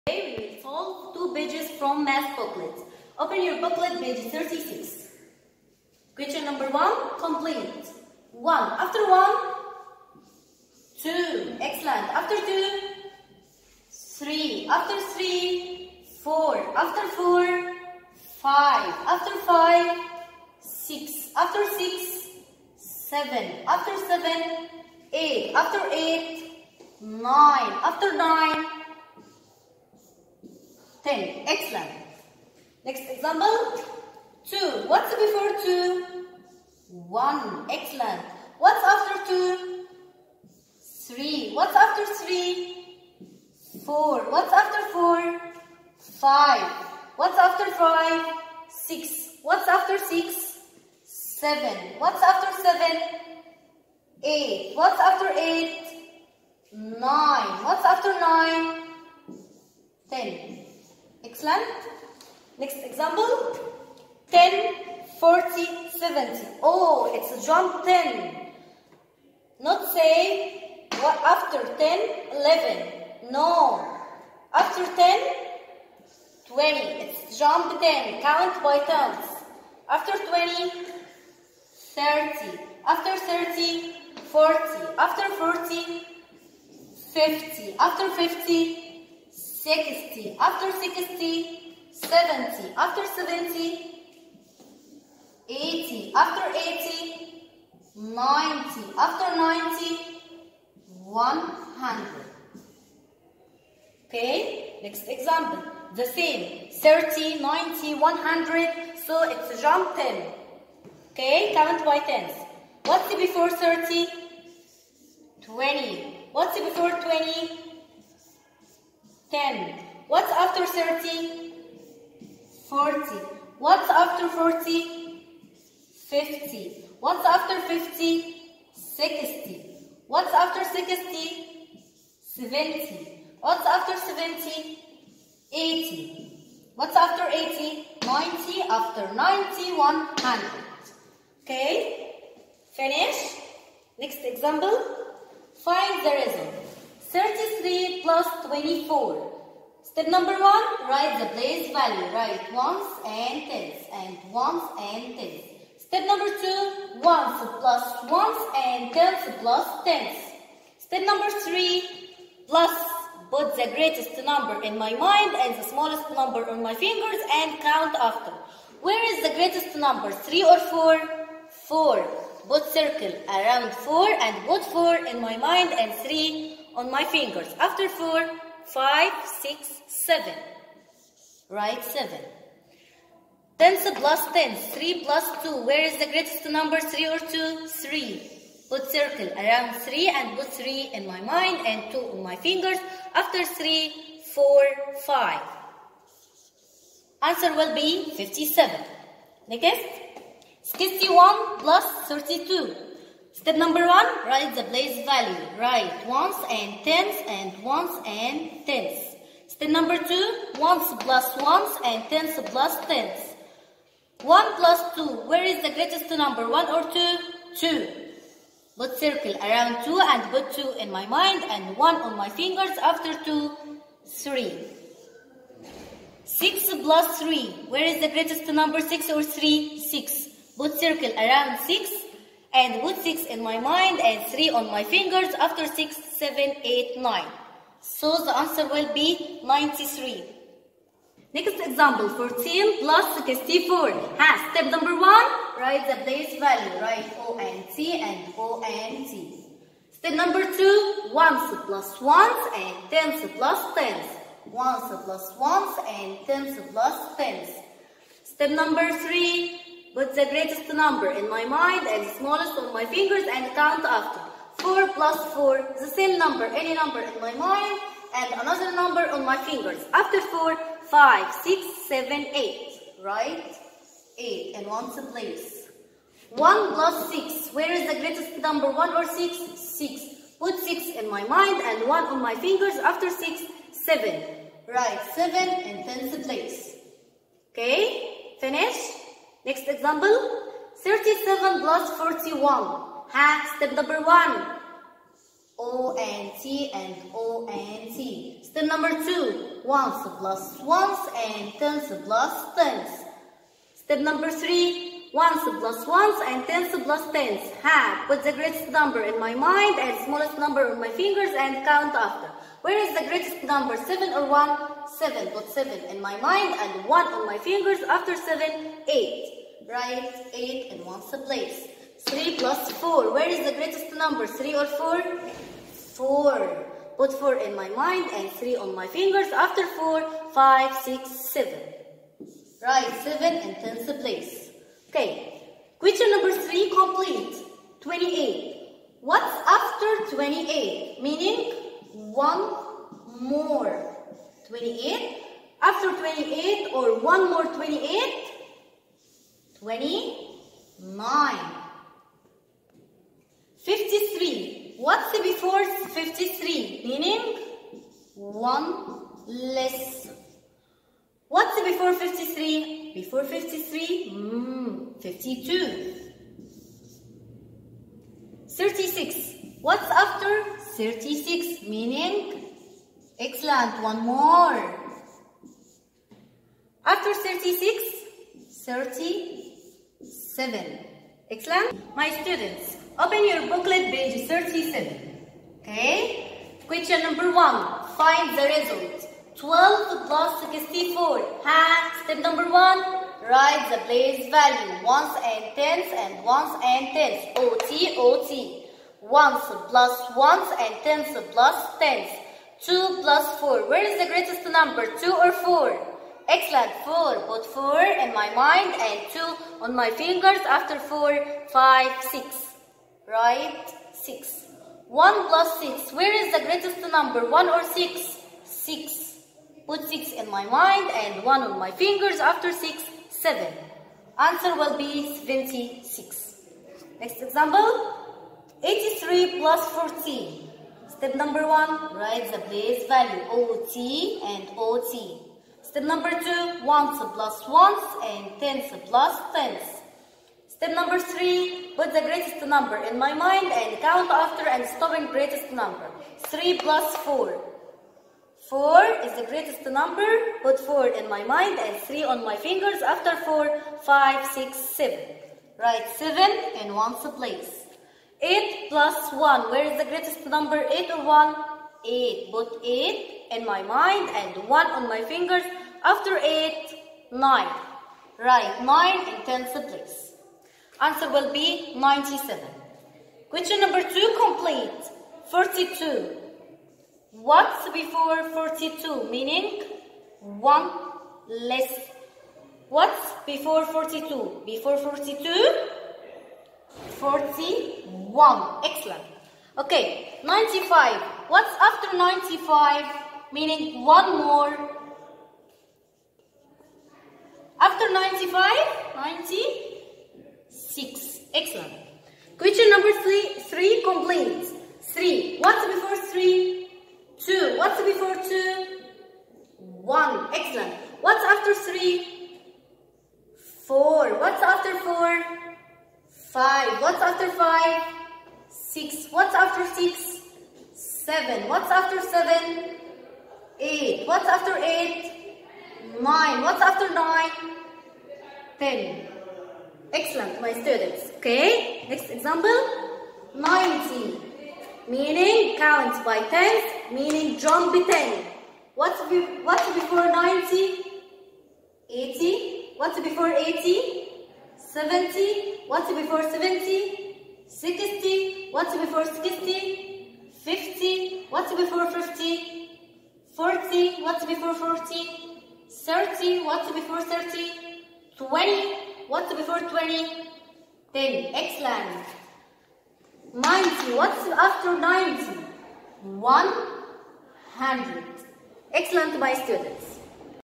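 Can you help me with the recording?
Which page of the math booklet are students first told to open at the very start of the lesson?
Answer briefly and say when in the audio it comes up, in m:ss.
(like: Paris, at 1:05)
36, at 0:04.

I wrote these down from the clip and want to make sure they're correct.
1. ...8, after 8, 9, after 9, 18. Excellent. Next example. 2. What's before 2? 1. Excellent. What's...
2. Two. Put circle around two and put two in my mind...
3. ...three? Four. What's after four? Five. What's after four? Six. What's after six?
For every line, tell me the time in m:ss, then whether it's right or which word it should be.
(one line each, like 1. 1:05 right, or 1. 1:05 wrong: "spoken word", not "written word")
1. 0:25 wrong: "10", not "18"
2. 3:37 right
3. 8:31 wrong: "five", not "four".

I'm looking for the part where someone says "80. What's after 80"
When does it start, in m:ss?
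2:15.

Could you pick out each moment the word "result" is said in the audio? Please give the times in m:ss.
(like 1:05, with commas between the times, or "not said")
2:26, 6:28.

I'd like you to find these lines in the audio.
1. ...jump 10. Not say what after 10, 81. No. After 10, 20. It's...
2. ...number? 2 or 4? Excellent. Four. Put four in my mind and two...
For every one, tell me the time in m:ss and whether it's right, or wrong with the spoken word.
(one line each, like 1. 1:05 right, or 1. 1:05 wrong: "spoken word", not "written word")
1. 1:07 wrong: "11", not "81"
2. 6:44 right.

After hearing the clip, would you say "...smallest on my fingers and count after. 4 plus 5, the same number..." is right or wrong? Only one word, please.
wrong.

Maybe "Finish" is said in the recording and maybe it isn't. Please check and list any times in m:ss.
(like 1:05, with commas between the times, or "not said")
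2:22, 4:48.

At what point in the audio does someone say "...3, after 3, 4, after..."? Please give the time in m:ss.
0:13.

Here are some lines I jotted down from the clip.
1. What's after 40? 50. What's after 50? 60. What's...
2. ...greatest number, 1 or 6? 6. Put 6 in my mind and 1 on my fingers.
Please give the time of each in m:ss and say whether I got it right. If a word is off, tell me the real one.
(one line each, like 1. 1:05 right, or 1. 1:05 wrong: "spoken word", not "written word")
1. 2:03 right
2. 4:37 right.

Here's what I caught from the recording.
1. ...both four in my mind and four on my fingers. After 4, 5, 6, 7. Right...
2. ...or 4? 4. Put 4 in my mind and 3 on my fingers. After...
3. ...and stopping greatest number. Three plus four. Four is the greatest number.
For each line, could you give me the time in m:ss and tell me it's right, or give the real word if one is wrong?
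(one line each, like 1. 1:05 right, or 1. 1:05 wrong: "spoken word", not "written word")
1. 2:54 wrong: "three", not "four"
2. 5:24 right
3. 7:24 right.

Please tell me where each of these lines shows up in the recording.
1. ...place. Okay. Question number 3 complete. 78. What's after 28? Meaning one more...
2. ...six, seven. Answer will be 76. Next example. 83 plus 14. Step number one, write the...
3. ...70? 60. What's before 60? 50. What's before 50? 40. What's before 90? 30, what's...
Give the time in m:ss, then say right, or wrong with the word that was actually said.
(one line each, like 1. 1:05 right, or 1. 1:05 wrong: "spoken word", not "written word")
1. 5:34 wrong: "28", not "78"
2. 7:02 right
3. 9:06 wrong: "40", not "90".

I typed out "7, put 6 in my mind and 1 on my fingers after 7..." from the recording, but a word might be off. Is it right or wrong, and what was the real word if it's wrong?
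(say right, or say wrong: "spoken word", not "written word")
wrong: "7", not "6".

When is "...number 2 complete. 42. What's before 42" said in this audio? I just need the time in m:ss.
7:53.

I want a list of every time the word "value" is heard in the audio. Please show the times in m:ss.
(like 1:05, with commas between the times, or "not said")
2:31, 3:25, 4:06, 6:34, 7:12.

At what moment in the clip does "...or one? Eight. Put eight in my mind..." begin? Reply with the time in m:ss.
7:40.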